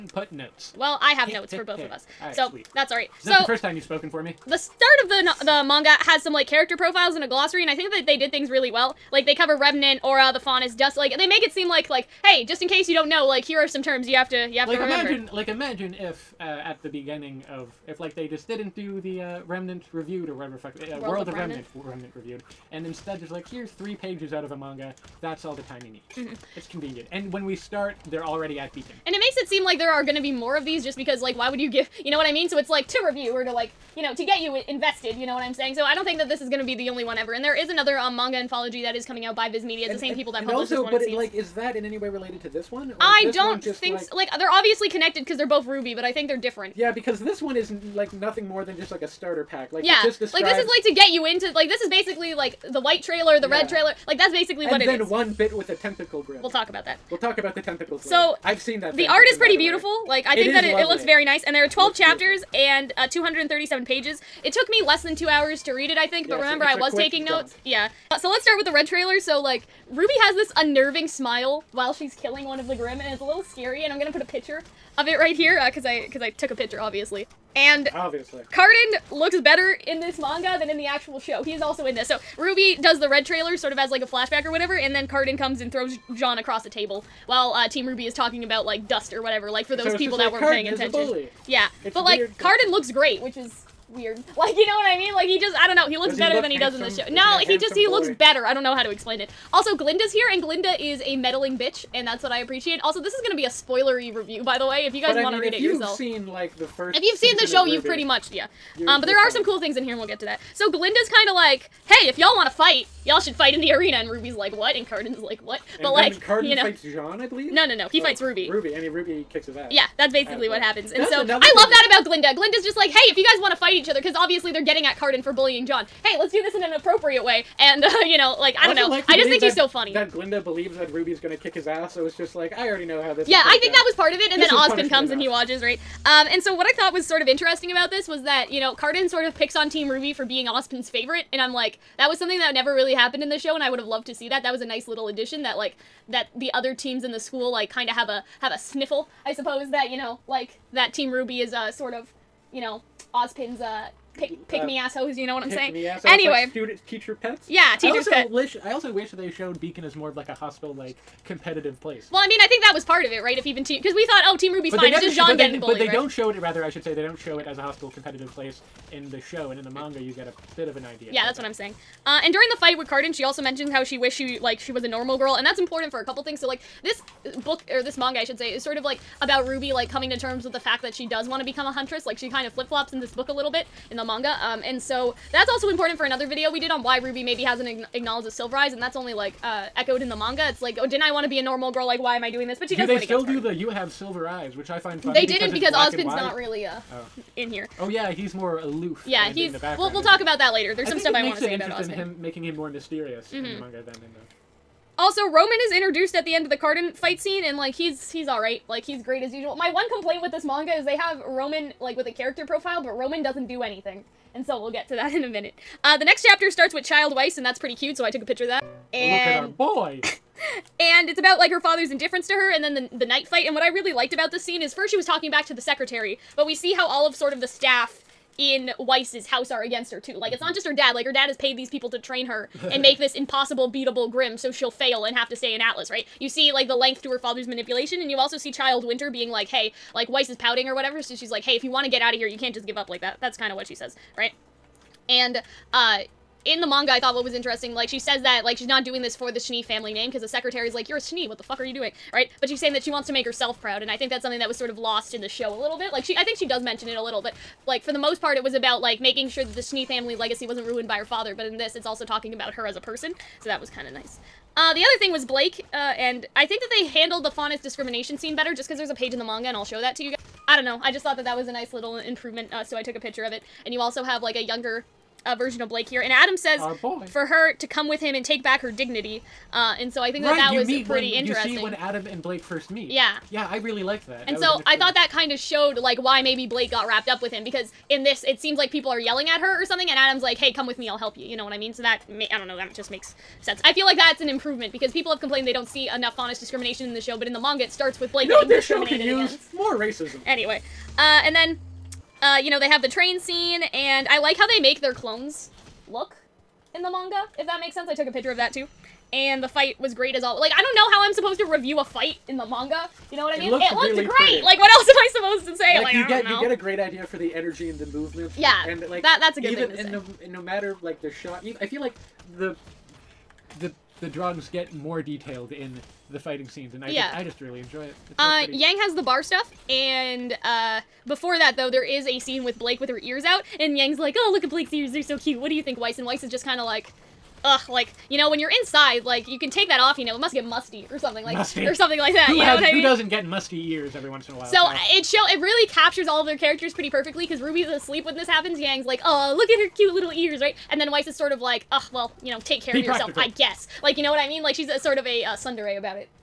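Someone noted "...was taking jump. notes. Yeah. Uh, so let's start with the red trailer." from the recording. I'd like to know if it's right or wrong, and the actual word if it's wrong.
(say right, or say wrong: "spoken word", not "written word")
right.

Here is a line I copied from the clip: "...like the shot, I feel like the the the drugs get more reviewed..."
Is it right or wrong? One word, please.
wrong.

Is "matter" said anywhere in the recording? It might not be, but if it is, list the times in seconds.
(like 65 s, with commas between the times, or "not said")
320 s.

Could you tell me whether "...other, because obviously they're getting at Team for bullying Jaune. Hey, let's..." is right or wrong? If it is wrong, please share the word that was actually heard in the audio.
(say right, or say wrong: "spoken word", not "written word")
wrong: "Cardin", not "Team".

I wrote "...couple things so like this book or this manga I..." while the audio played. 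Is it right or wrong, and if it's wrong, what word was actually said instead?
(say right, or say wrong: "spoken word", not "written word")
right.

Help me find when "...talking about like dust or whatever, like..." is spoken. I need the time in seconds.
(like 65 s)
88 s.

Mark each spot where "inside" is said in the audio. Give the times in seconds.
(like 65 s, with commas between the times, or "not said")
338 s.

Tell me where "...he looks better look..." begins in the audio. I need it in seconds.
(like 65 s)
95 s.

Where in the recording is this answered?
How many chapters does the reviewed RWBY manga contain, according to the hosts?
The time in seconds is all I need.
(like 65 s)
61 s.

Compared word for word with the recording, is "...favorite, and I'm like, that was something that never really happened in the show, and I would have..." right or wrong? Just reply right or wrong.
right.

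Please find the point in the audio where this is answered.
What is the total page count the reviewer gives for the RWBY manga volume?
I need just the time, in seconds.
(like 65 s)
63 s.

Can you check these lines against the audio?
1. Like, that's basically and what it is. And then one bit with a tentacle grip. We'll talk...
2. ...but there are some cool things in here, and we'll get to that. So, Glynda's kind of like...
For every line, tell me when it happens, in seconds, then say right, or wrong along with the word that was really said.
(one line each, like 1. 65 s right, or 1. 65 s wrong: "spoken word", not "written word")
1. 54 s right
2. 109 s right.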